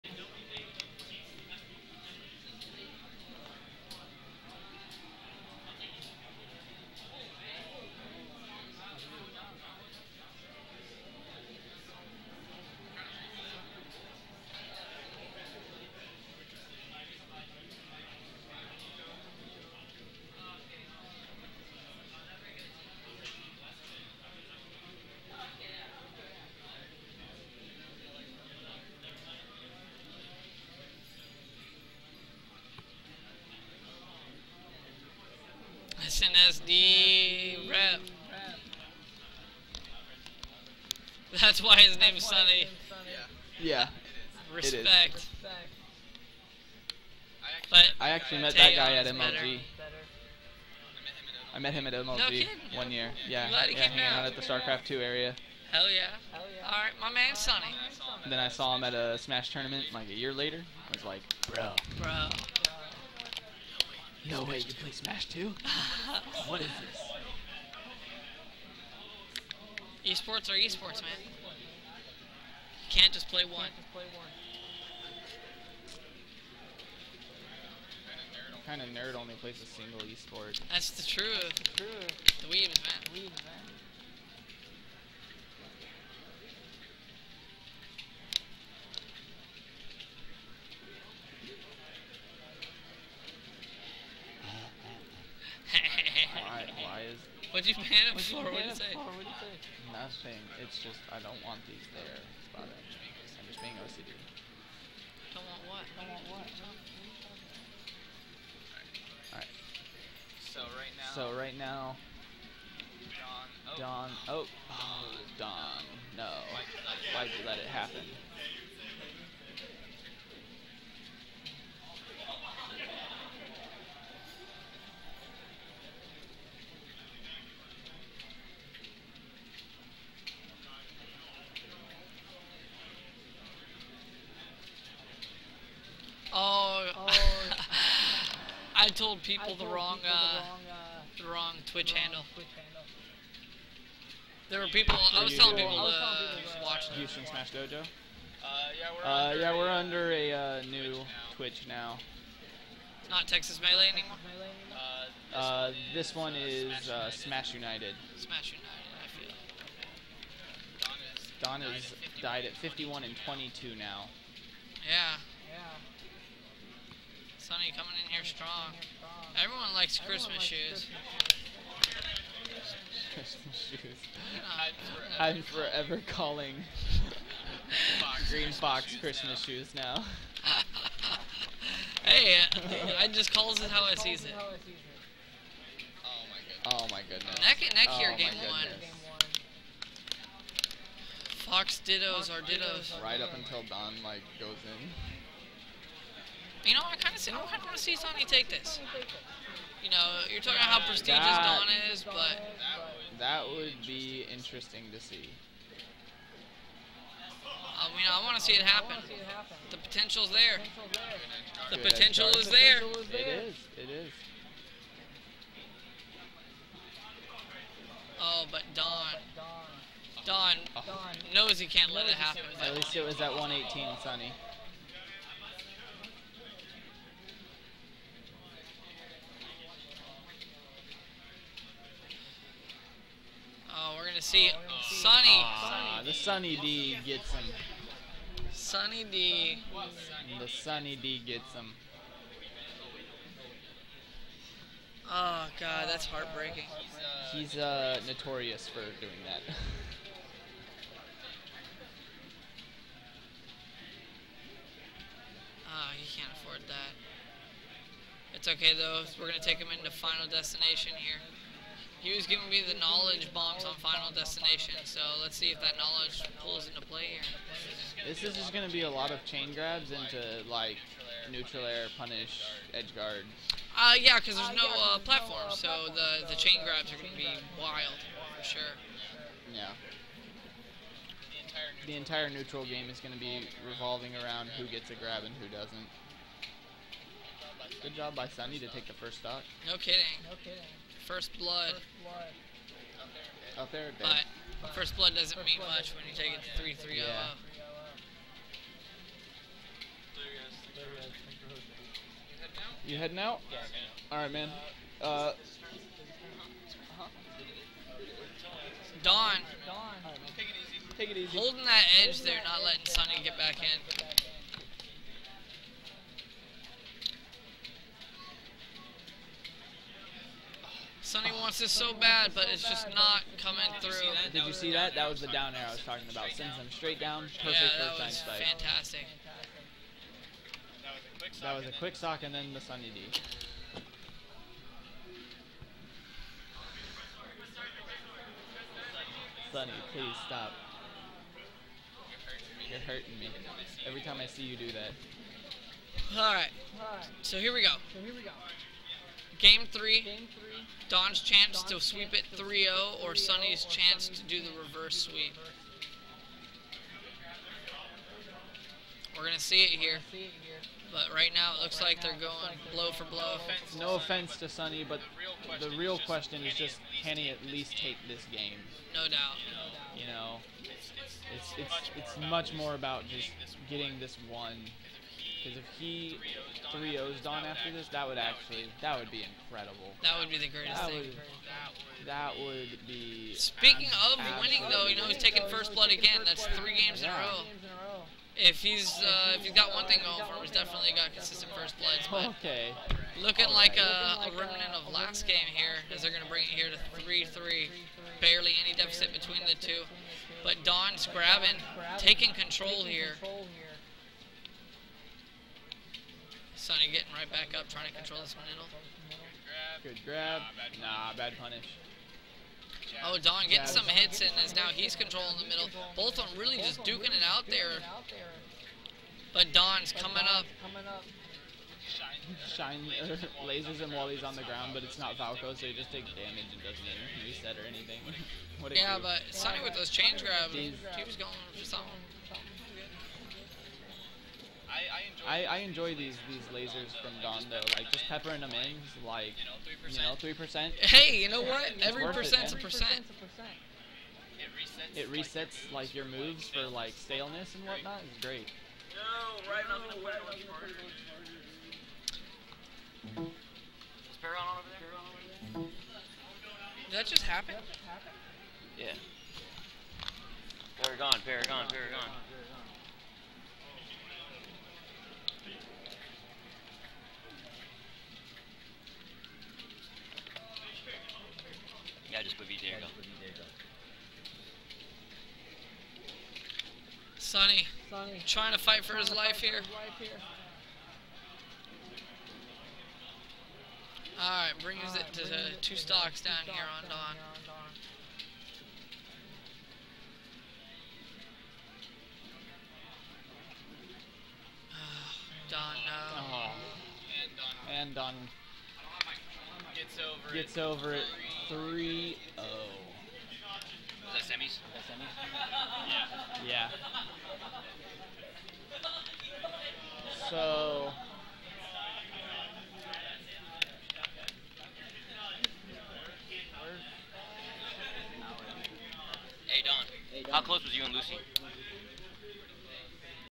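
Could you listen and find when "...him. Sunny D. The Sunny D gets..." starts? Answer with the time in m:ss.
3:57.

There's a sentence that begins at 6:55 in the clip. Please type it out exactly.
Both of them really just duking it out there.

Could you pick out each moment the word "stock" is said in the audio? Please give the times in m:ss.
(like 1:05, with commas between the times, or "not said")
4:49, 8:05.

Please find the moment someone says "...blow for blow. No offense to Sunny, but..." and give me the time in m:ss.
6:02.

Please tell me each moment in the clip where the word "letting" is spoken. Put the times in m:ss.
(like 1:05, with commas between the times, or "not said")
5:12.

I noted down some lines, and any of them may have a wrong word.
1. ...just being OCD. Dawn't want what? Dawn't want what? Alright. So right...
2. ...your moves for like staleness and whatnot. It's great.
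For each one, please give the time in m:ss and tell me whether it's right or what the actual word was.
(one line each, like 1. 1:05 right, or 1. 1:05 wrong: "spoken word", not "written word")
1. 1:43 right
2. 7:25 right.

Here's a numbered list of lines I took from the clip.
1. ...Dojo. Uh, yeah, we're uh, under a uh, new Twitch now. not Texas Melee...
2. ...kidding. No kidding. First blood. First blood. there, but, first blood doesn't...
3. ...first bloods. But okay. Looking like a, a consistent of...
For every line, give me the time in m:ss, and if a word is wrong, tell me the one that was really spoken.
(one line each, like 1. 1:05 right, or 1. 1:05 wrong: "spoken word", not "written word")
1. 2:27 right
2. 4:49 right
3. 6:31 wrong: "remnant", not "consistent".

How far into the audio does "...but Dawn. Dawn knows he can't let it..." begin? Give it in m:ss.
3:38.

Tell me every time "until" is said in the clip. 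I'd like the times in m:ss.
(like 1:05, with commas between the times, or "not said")
3:13.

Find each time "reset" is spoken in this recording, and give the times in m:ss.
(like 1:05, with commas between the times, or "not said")
7:07, 7:25.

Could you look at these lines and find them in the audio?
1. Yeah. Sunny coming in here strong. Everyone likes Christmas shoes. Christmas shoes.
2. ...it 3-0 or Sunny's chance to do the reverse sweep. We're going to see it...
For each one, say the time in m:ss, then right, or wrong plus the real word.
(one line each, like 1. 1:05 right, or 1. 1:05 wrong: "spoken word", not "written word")
1. 2:45 right
2. 5:52 right.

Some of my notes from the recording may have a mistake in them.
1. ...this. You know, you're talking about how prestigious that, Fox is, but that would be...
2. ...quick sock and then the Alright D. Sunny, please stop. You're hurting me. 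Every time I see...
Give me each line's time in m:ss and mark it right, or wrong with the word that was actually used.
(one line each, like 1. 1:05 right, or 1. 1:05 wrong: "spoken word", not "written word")
1. 3:18 wrong: "Dawn", not "Fox"
2. 5:31 wrong: "Sunny", not "Alright".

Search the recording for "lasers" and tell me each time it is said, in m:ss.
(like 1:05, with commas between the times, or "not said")
7:03, 7:16.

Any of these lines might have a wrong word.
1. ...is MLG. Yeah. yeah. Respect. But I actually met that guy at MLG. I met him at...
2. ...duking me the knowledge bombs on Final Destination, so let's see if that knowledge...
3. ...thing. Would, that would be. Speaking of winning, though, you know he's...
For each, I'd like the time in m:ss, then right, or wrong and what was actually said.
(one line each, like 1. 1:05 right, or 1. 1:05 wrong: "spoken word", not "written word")
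1. 0:42 wrong: "Sunny", not "MLG"
2. 4:22 wrong: "giving", not "duking"
3. 6:20 right.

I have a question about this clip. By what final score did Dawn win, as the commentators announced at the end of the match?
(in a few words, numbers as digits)
3-0.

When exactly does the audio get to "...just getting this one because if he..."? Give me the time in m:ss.
6:13.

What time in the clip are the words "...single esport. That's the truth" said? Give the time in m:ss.
1:19.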